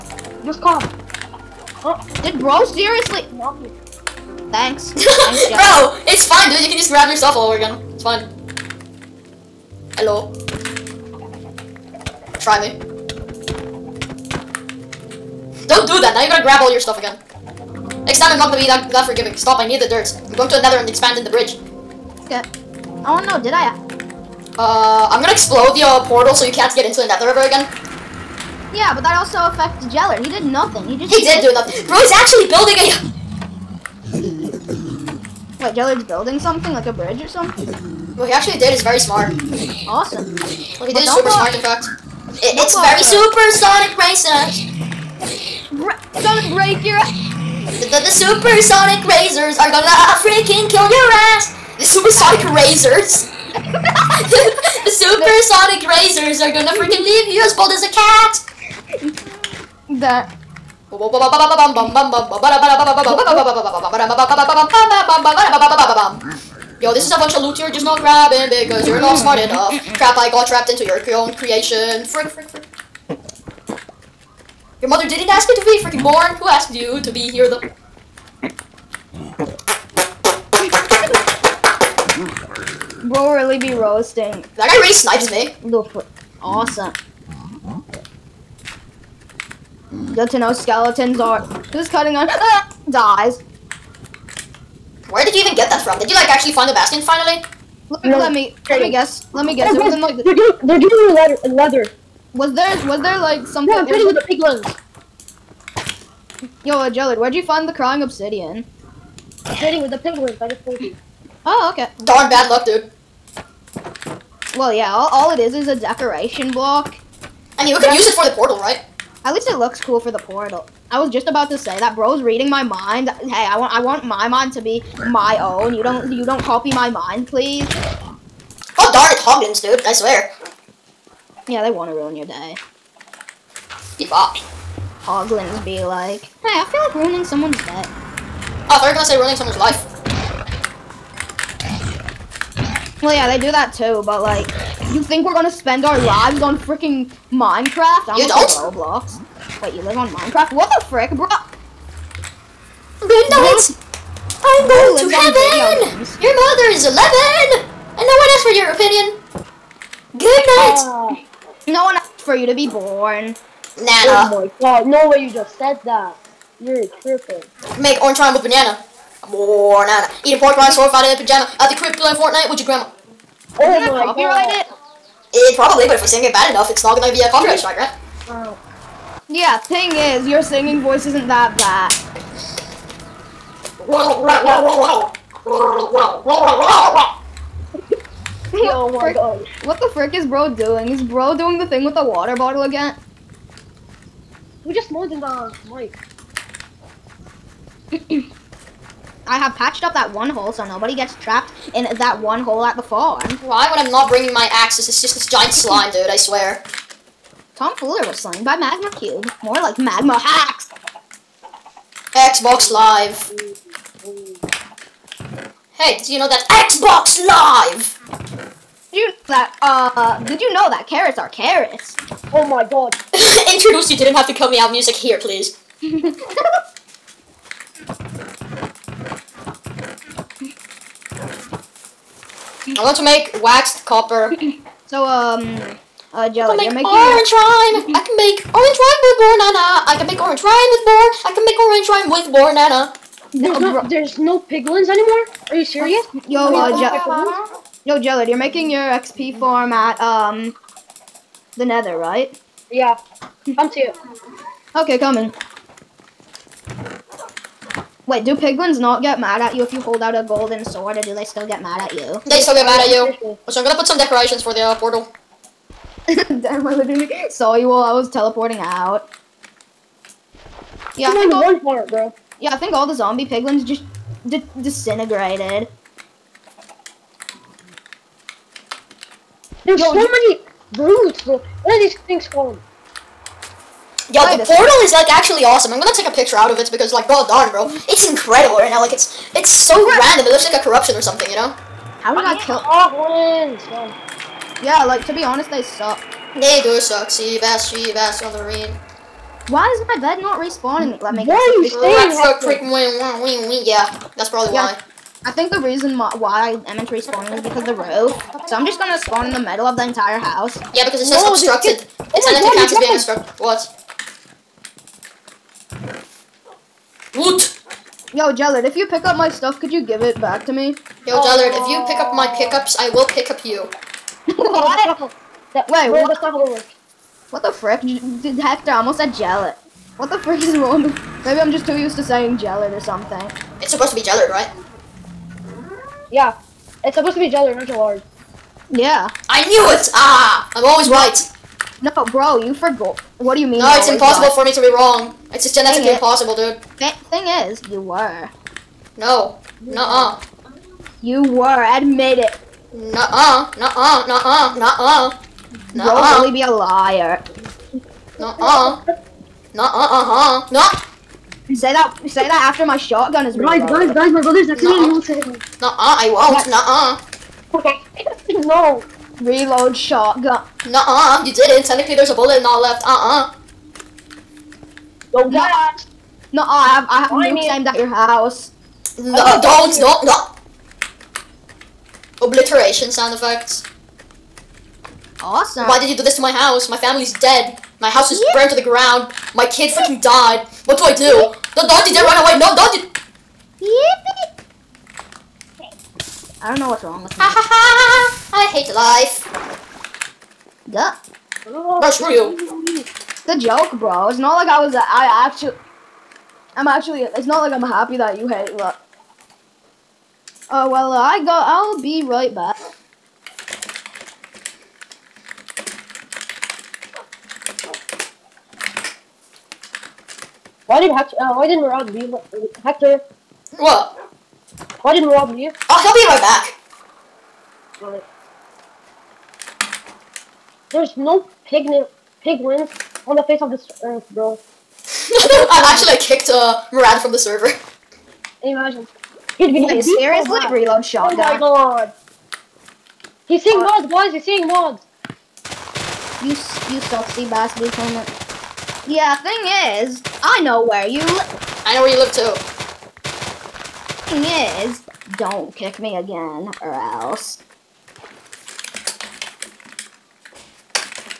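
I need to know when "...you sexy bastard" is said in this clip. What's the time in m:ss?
7:26.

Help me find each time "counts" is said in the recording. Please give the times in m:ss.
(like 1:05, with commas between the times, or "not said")
5:12.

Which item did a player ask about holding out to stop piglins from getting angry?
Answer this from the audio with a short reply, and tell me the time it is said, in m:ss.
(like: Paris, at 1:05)
golden sword, at 4:20.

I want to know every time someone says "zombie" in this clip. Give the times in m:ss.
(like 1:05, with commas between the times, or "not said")
4:32.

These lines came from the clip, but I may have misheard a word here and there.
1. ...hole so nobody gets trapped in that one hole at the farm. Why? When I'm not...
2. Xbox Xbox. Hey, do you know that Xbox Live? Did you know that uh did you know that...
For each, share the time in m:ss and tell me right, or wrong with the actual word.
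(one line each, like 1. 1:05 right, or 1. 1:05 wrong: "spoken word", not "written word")
1. 3:20 right
2. 3:32 wrong: "Live", not "Xbox".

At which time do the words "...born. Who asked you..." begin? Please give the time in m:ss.
1:16.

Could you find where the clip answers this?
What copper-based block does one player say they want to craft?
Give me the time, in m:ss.
3:53.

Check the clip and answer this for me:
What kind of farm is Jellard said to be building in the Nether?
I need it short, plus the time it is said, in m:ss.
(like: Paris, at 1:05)
XP farm, at 4:08.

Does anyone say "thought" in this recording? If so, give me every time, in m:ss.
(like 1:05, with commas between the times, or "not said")
2:18.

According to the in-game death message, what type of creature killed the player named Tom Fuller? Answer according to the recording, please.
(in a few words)
Magma Cube.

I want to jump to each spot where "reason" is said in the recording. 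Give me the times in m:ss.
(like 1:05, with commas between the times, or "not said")
5:05.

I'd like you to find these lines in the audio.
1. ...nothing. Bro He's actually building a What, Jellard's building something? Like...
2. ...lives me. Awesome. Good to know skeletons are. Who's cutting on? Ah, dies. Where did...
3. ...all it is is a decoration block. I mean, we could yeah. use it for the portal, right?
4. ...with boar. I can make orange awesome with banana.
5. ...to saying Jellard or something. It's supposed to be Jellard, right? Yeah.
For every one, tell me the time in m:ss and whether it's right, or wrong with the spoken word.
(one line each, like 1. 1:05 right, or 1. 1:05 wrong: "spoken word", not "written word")
1. 0:31 right
2. 1:24 wrong: "snipes", not "lives"
3. 1:55 right
4. 4:00 wrong: "rhyme", not "awesome"
5. 5:31 right.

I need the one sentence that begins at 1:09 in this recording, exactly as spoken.
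Crap, I got trapped into your own creation.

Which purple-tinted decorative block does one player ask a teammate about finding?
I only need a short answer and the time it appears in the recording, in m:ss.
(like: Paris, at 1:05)
crying obsidian, at 1:47.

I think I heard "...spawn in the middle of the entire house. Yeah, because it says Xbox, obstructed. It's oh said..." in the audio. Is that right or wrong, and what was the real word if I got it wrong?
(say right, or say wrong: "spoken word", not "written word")
wrong: "Whoa", not "Xbox".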